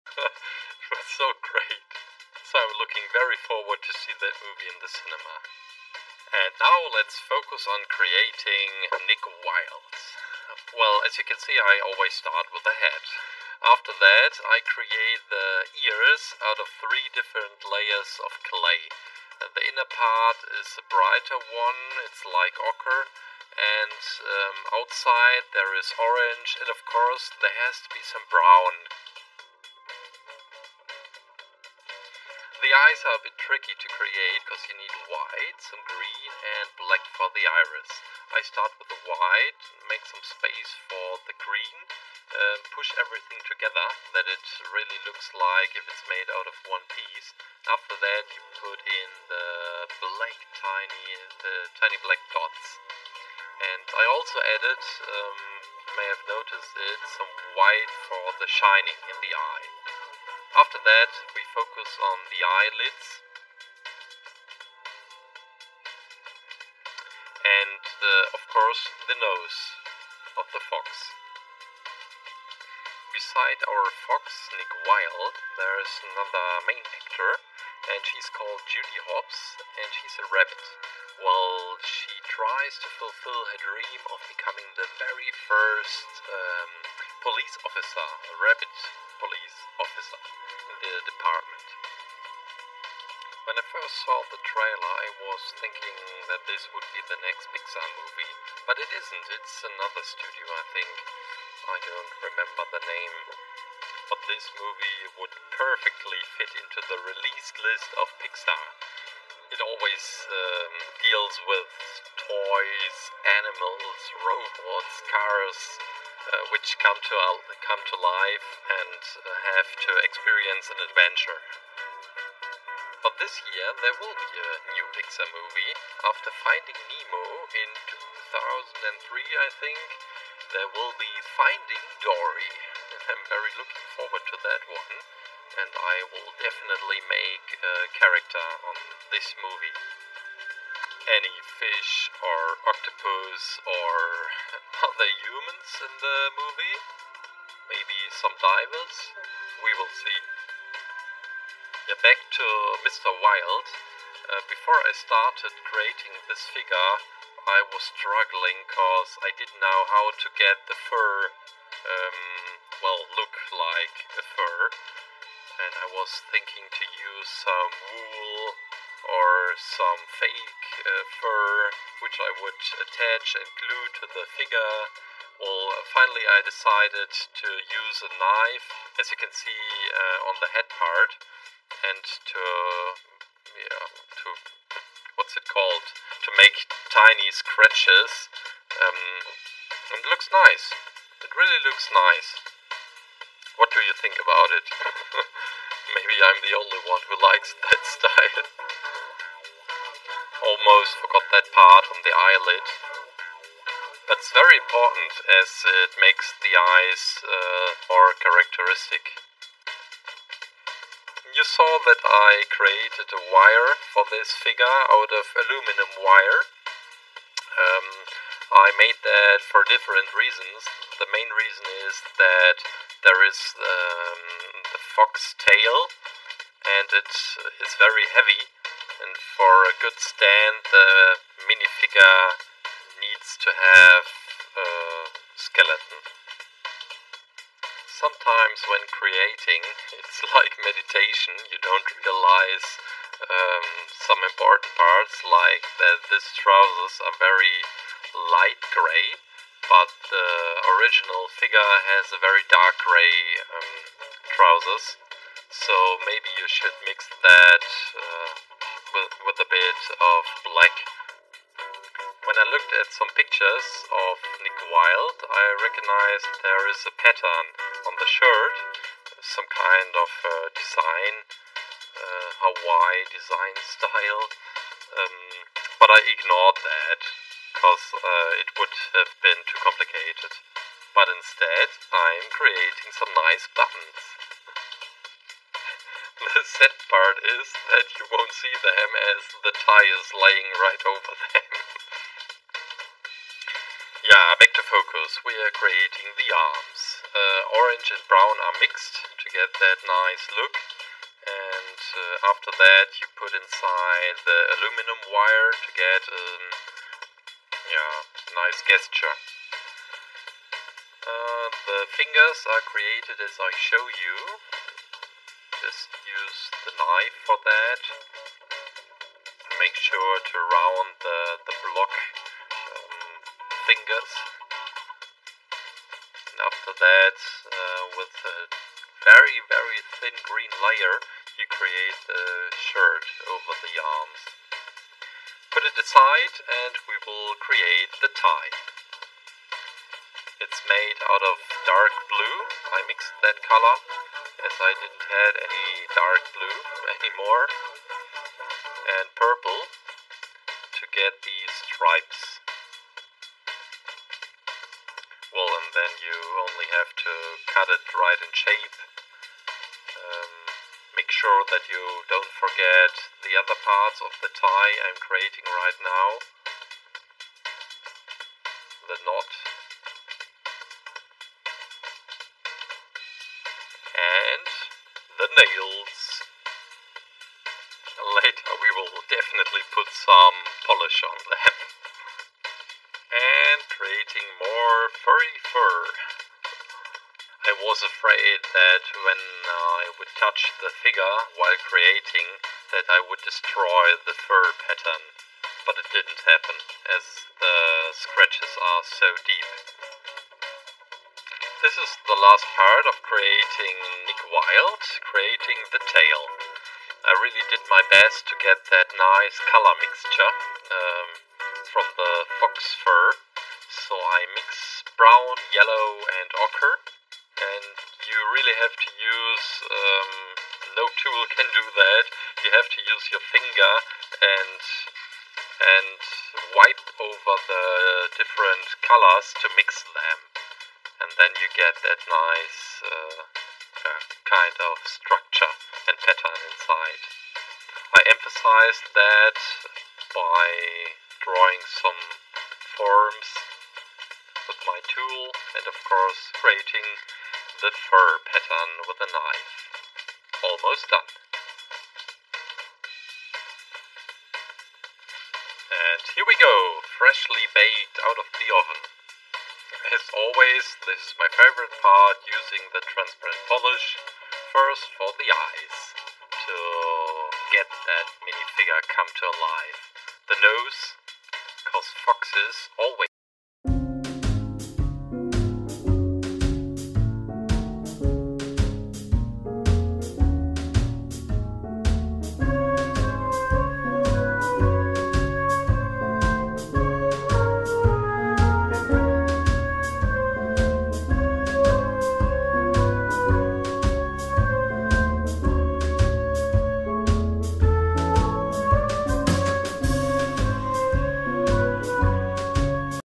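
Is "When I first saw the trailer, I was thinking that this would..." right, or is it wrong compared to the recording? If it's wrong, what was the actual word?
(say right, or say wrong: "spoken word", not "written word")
right.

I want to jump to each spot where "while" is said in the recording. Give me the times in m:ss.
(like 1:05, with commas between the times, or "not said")
1:21, 6:31.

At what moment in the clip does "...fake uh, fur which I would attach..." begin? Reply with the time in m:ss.
2:50.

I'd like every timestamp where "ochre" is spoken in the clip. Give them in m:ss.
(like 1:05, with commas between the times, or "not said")
0:22, 6:56.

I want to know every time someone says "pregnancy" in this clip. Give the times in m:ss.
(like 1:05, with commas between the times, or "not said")
not said.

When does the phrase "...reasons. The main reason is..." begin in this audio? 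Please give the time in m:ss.
3:40.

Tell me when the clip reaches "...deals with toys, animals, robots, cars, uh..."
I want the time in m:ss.
1:51.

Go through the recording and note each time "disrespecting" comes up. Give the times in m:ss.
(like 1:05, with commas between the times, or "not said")
not said.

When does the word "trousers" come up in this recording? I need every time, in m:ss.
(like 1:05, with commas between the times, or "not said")
4:06, 4:14.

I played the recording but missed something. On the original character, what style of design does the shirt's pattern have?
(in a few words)
Hawaii design style.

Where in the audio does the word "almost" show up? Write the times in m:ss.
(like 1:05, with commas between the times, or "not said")
3:20, 7:30.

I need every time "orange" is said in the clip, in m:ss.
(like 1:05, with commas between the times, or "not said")
0:25, 4:57.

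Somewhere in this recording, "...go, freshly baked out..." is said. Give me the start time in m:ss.
7:36.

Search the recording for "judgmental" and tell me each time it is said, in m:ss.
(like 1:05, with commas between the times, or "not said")
not said.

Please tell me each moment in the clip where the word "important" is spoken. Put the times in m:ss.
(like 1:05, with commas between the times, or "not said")
3:24, 4:04.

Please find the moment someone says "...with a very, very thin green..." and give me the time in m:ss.
5:27.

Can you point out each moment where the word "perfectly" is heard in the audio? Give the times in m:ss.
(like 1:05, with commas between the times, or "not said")
1:45.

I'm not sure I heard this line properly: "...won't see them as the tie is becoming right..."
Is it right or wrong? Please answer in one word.
wrong.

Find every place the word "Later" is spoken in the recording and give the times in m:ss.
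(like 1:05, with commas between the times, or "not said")
6:18.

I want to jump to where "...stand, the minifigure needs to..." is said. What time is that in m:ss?
3:49.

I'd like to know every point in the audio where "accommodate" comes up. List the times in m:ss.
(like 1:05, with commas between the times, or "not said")
not said.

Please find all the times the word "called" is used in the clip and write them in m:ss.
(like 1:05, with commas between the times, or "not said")
1:18, 3:05.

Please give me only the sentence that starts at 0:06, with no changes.
And now let's focus on creating Nick Wilde.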